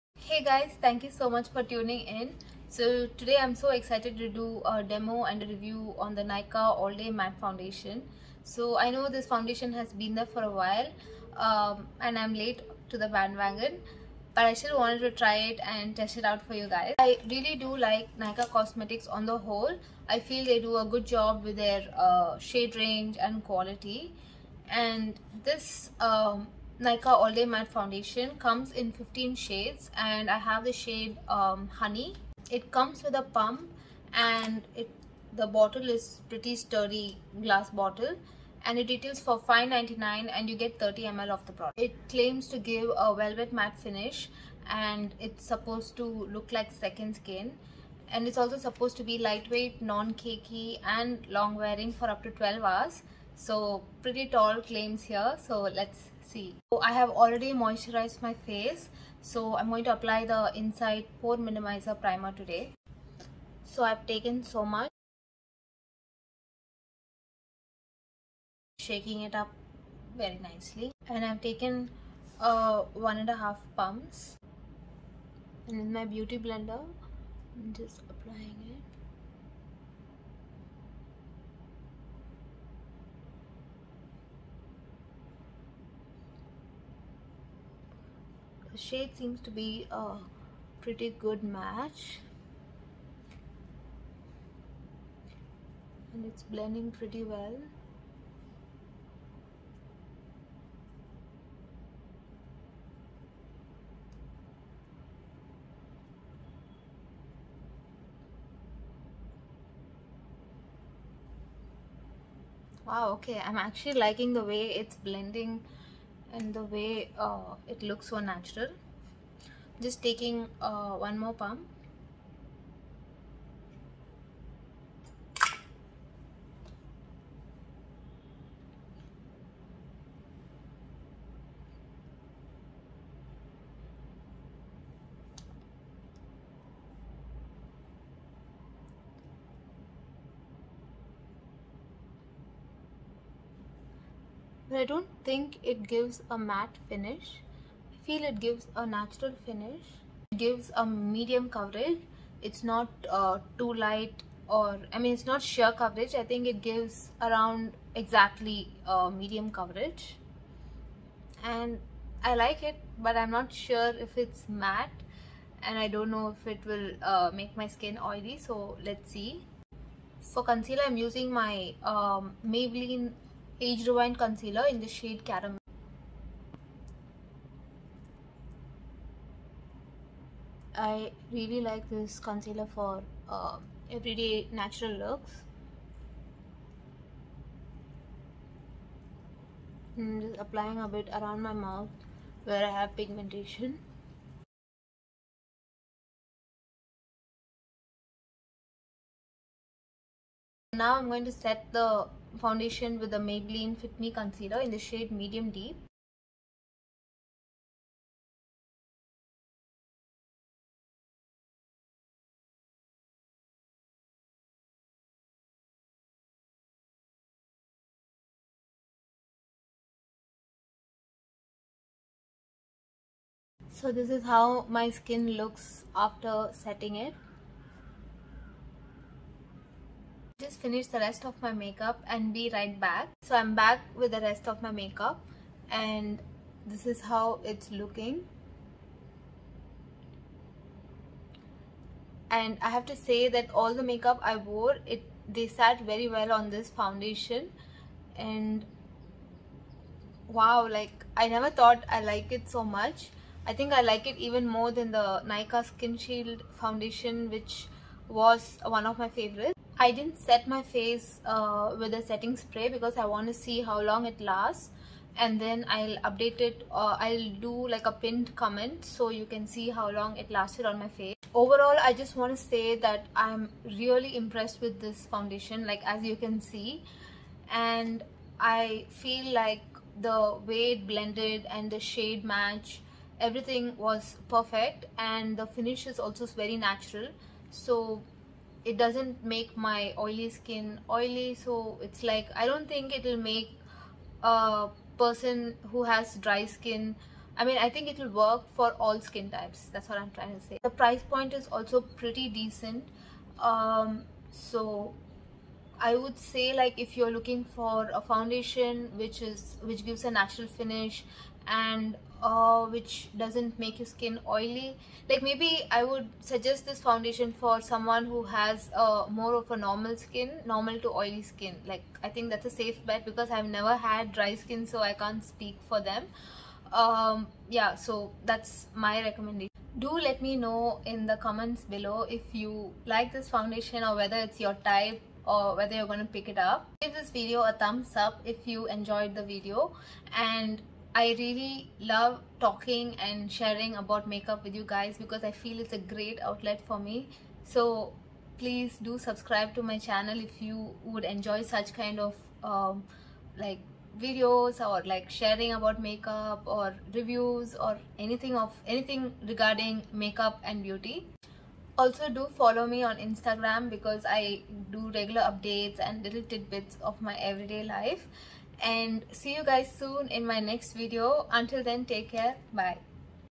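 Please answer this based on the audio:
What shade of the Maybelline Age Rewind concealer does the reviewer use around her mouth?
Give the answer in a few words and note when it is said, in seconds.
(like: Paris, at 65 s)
Caramel, at 175 s.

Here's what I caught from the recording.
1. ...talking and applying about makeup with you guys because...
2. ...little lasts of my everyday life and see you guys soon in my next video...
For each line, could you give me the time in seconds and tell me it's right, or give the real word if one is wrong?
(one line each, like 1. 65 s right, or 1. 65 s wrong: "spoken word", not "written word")
1. 342 s wrong: "sharing", not "applying"
2. 366 s wrong: "tidbits", not "lasts".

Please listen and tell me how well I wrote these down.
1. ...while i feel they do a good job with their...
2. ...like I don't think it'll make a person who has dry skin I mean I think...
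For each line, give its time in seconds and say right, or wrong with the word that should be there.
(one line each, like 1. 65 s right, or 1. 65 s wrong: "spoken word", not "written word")
1. 19 s wrong: "whole", not "while"
2. 292 s right.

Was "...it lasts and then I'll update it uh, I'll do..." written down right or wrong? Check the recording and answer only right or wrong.
right.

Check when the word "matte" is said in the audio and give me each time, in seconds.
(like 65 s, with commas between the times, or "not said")
7 s, 27 s, 43 s, 146 s, 164 s.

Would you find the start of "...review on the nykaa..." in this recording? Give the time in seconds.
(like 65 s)
5 s.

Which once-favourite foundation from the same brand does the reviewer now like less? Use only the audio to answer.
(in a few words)
Nykaa Skin Shield.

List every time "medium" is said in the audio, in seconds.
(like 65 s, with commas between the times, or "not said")
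150 s, 159 s, 205 s.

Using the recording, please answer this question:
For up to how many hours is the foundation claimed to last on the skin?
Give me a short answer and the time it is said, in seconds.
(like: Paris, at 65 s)
12 hours, at 52 s.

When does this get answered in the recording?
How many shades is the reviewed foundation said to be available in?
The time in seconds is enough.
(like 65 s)
28 s.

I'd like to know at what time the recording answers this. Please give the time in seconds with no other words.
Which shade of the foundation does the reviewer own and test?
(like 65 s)
31 s.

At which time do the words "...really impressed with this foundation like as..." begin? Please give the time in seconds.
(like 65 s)
273 s.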